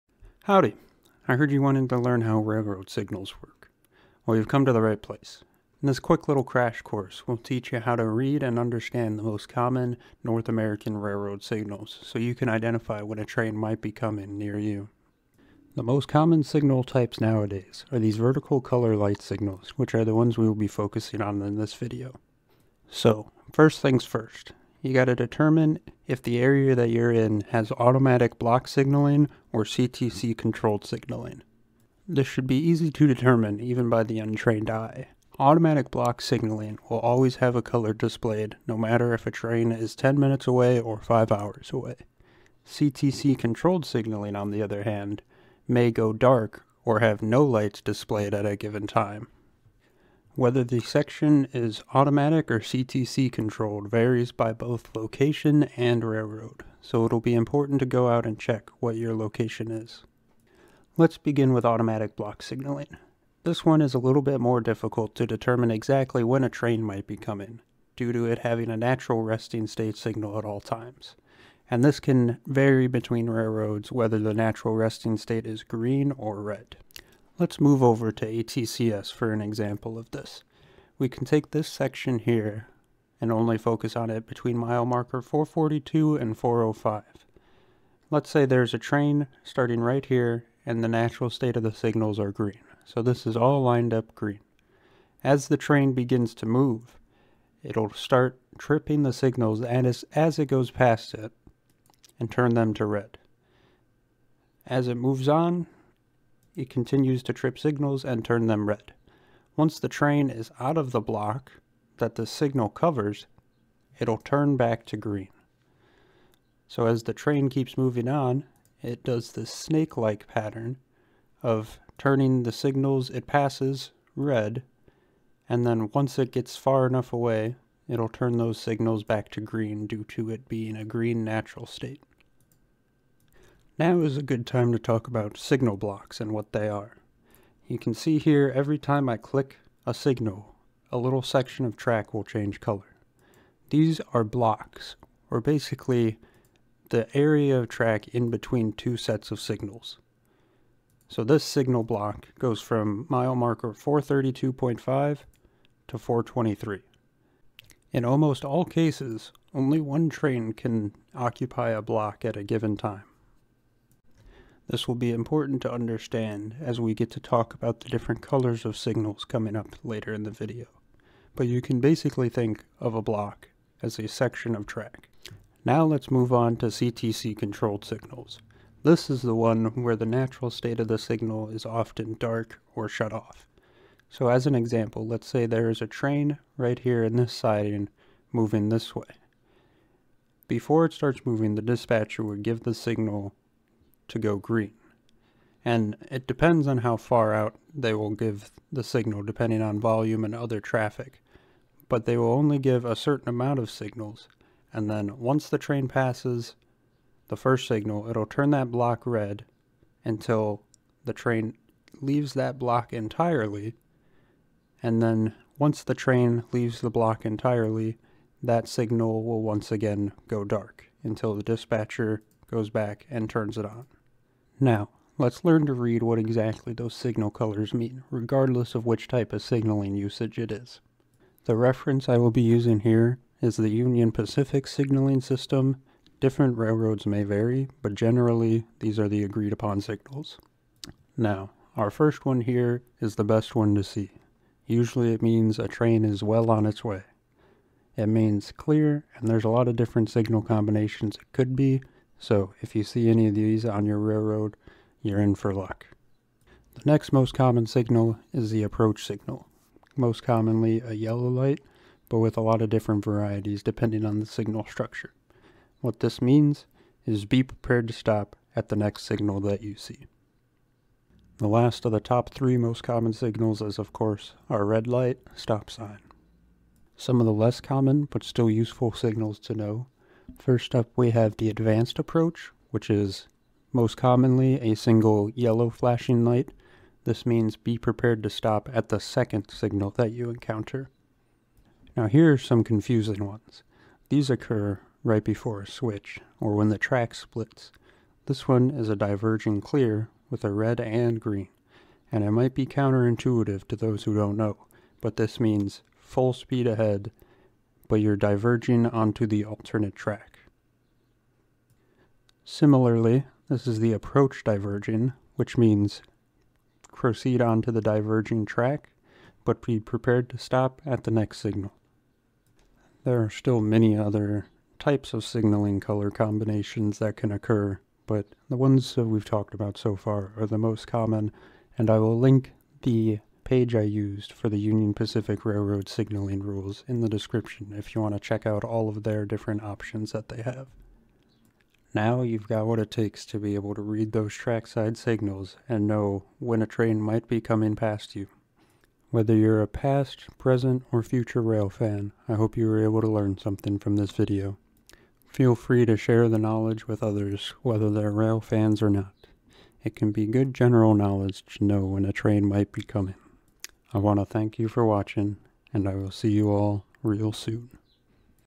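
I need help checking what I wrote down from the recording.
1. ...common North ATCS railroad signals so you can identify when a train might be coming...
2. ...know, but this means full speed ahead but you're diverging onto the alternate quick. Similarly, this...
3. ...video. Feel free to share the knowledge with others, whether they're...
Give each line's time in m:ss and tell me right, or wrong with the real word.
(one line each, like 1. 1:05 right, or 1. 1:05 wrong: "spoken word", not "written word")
1. 0:09 wrong: "American", not "ATCS"
2. 5:04 wrong: "track", not "quick"
3. 5:54 right.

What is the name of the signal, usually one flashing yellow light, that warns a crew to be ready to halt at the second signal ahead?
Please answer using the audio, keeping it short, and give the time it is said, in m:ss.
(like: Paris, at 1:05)
advanced approach, at 4:41.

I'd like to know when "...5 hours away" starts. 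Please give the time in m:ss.
0:40.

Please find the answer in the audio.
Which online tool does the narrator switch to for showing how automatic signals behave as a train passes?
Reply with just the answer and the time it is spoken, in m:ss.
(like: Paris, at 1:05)
ATCS, at 1:18.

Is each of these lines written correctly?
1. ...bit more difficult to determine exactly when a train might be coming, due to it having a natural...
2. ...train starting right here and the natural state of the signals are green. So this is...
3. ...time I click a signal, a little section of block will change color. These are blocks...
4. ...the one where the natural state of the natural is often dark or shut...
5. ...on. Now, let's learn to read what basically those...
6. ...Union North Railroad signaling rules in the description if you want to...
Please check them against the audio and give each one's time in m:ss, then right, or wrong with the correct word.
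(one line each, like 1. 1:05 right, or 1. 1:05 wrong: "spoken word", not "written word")
1. 1:04 right
2. 1:28 right
3. 2:18 wrong: "track", not "block"
4. 2:59 wrong: "signal", not "natural"
5. 3:43 wrong: "exactly", not "basically"
6. 5:34 wrong: "Pacific", not "North".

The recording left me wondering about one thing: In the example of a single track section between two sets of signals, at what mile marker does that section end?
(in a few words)
423.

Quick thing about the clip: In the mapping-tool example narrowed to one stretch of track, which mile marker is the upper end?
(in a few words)
442.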